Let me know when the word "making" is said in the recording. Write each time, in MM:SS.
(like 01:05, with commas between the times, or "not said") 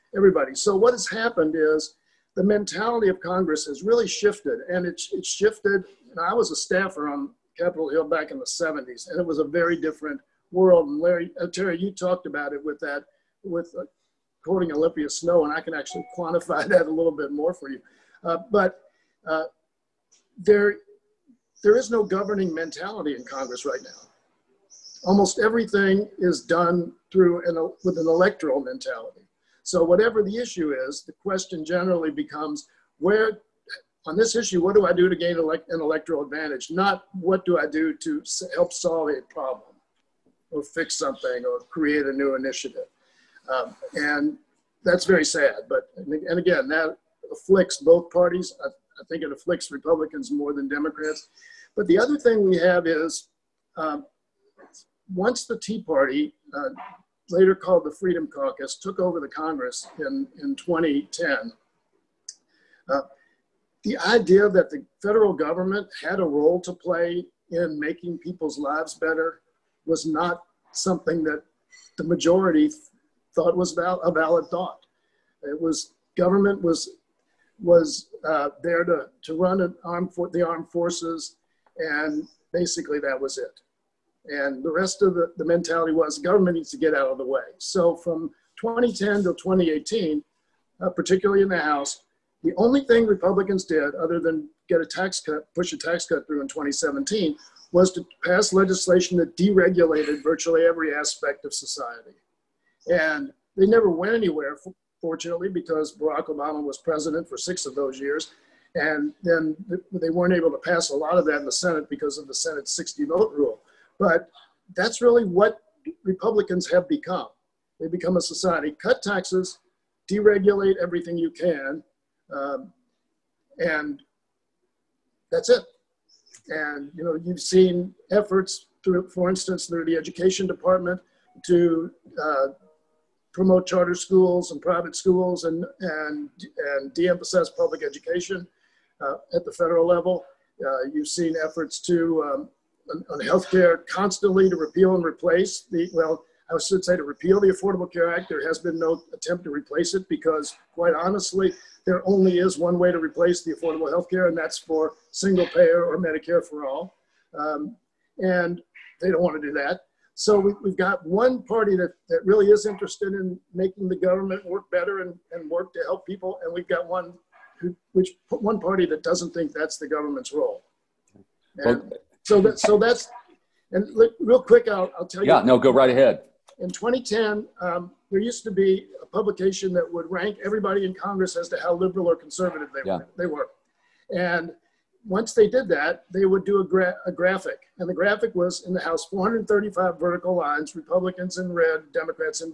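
01:07, 02:43.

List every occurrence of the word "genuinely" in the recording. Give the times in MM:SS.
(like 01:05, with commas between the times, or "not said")
not said.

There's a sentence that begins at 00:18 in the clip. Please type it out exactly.
Uh, but uh, there, there is no governing mentality in Congress right now.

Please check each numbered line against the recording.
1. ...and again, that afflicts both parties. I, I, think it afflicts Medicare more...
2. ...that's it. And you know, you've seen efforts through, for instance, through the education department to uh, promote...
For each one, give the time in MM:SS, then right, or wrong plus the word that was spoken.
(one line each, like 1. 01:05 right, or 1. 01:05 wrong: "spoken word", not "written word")
1. 00:45 wrong: "Republicans", not "Medicare"
2. 02:05 right.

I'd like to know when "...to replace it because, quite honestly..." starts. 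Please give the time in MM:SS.
02:29.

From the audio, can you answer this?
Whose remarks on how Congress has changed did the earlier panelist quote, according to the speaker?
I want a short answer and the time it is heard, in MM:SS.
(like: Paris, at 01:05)
Olympia Snowe, at 00:14.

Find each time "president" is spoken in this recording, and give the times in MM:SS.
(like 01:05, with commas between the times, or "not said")
01:46.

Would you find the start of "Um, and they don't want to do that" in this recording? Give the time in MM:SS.
02:37.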